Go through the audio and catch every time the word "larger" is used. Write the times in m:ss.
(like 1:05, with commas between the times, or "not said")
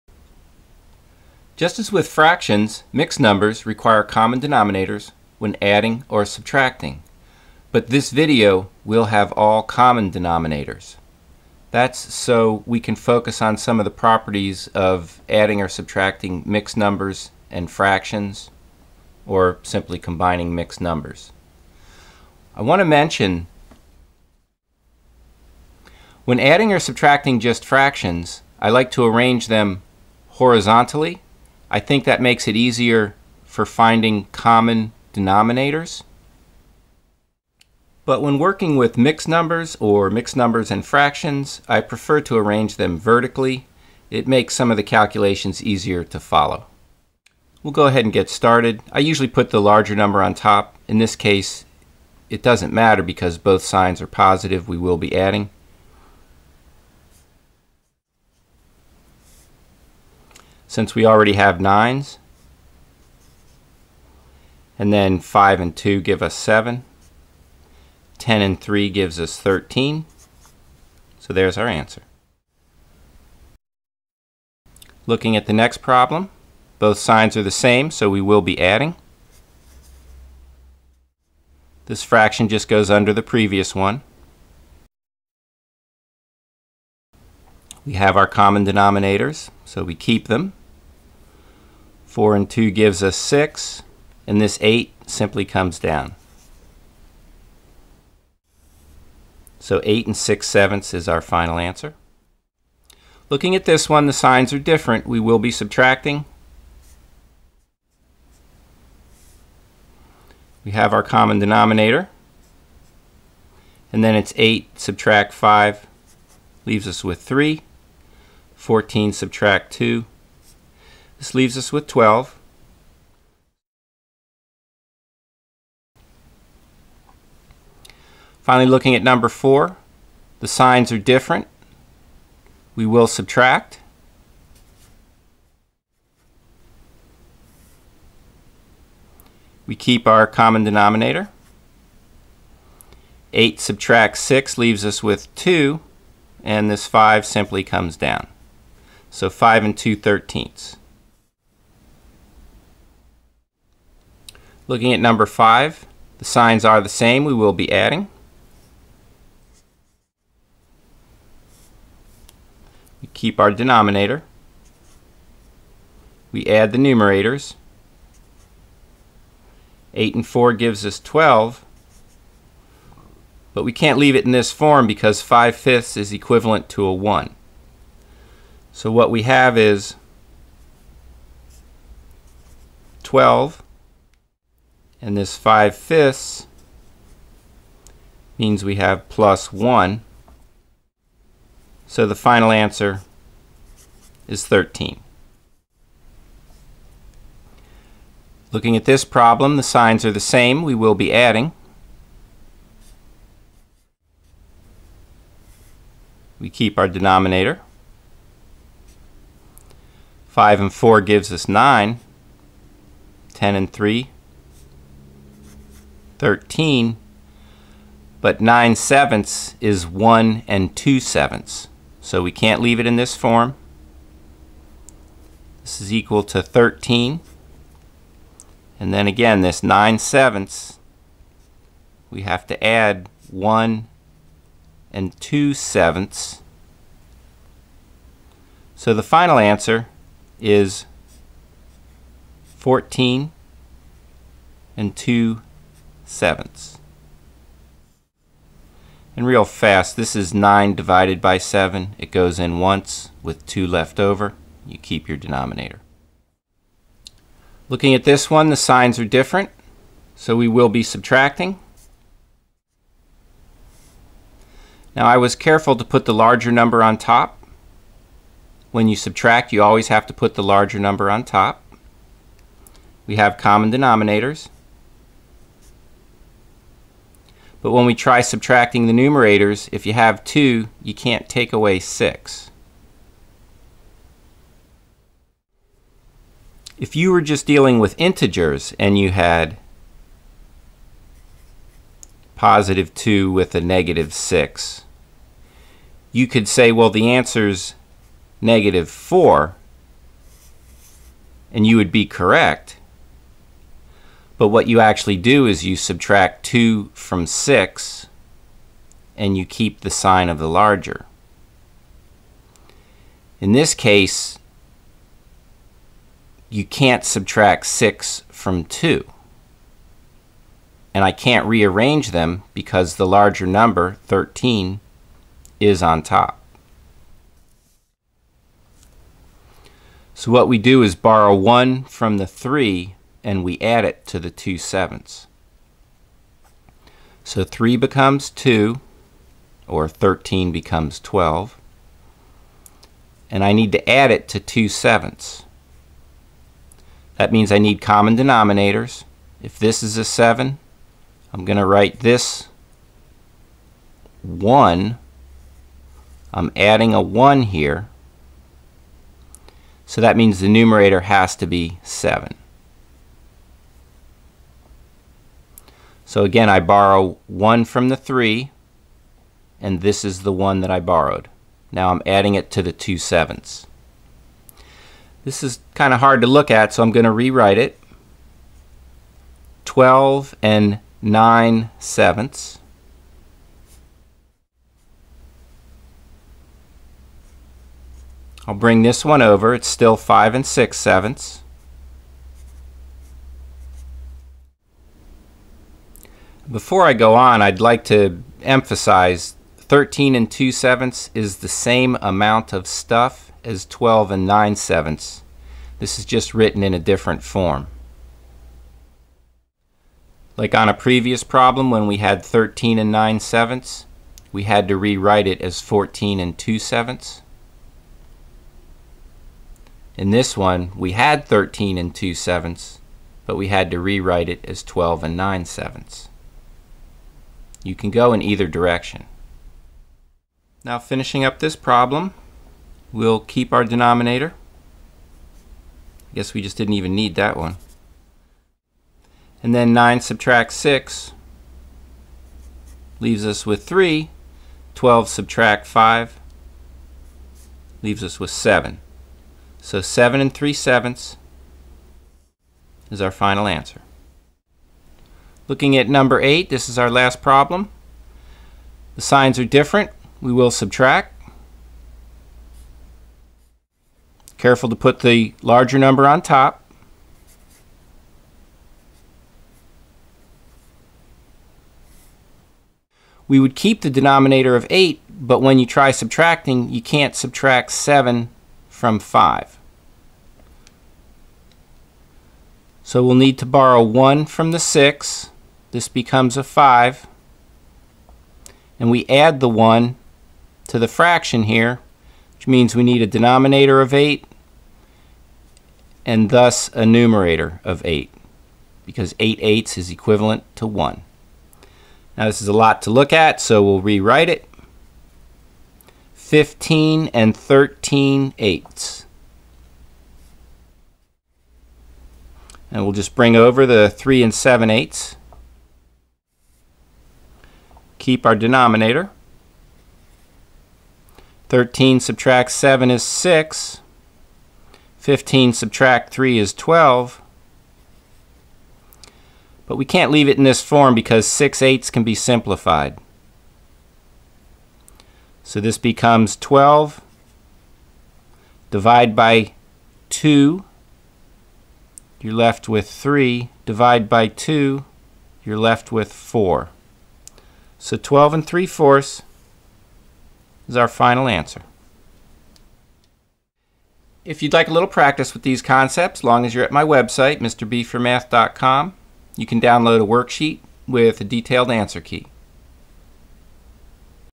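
0:49, 4:26, 4:30, 5:10, 5:23, 7:45.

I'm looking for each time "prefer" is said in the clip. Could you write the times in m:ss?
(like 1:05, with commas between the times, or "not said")
0:41.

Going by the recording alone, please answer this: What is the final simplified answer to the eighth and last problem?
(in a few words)
12 and 3 fourths.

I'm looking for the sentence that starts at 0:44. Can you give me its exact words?
It makes some of the calculations easier to follow.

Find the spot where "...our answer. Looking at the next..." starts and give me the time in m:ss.
1:11.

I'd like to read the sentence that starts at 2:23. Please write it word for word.
8 subtract 6 leaves us with 2, and this 5 simply comes down.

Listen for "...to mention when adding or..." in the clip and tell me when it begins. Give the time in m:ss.
0:22.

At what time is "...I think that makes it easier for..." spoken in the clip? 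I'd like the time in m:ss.
0:31.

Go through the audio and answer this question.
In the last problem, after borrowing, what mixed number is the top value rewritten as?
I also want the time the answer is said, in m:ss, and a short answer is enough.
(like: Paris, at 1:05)
15 and 13 eighths, at 8:26.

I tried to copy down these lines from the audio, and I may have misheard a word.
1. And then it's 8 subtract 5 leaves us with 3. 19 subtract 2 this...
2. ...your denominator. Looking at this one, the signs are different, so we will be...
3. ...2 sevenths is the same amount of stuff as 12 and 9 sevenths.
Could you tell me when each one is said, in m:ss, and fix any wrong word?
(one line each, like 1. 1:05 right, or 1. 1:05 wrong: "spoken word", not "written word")
1. 1:53 wrong: "14", not "19"
2. 4:15 right
3. 6:40 right.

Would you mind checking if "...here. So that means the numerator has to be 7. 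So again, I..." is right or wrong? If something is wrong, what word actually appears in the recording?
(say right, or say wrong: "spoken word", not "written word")
right.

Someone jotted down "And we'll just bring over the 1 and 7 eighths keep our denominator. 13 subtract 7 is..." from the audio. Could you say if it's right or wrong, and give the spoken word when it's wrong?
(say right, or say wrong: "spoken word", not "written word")
wrong: "3", not "1".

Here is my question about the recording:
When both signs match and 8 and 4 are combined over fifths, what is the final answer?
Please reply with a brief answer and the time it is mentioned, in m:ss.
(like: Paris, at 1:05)
13, at 3:14.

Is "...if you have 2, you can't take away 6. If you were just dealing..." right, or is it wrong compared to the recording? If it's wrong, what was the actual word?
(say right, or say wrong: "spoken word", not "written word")
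right.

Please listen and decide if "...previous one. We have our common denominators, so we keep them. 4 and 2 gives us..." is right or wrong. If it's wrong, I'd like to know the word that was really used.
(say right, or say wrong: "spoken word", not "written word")
right.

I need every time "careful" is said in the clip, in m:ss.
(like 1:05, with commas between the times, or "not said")
4:25, 7:44.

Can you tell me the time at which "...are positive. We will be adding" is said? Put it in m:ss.
0:54.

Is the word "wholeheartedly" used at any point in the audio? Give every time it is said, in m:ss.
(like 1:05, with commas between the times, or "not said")
not said.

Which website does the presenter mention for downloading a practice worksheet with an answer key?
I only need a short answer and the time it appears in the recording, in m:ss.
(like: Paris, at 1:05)
mrb4math.com, at 9:17.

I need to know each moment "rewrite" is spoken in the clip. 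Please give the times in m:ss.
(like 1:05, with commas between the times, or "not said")
6:17, 6:54, 7:03, 8:23.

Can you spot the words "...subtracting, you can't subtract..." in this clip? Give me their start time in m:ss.
7:55.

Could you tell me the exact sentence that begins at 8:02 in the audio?
So we'll need to borrow 1 from the 6 this becomes a 5.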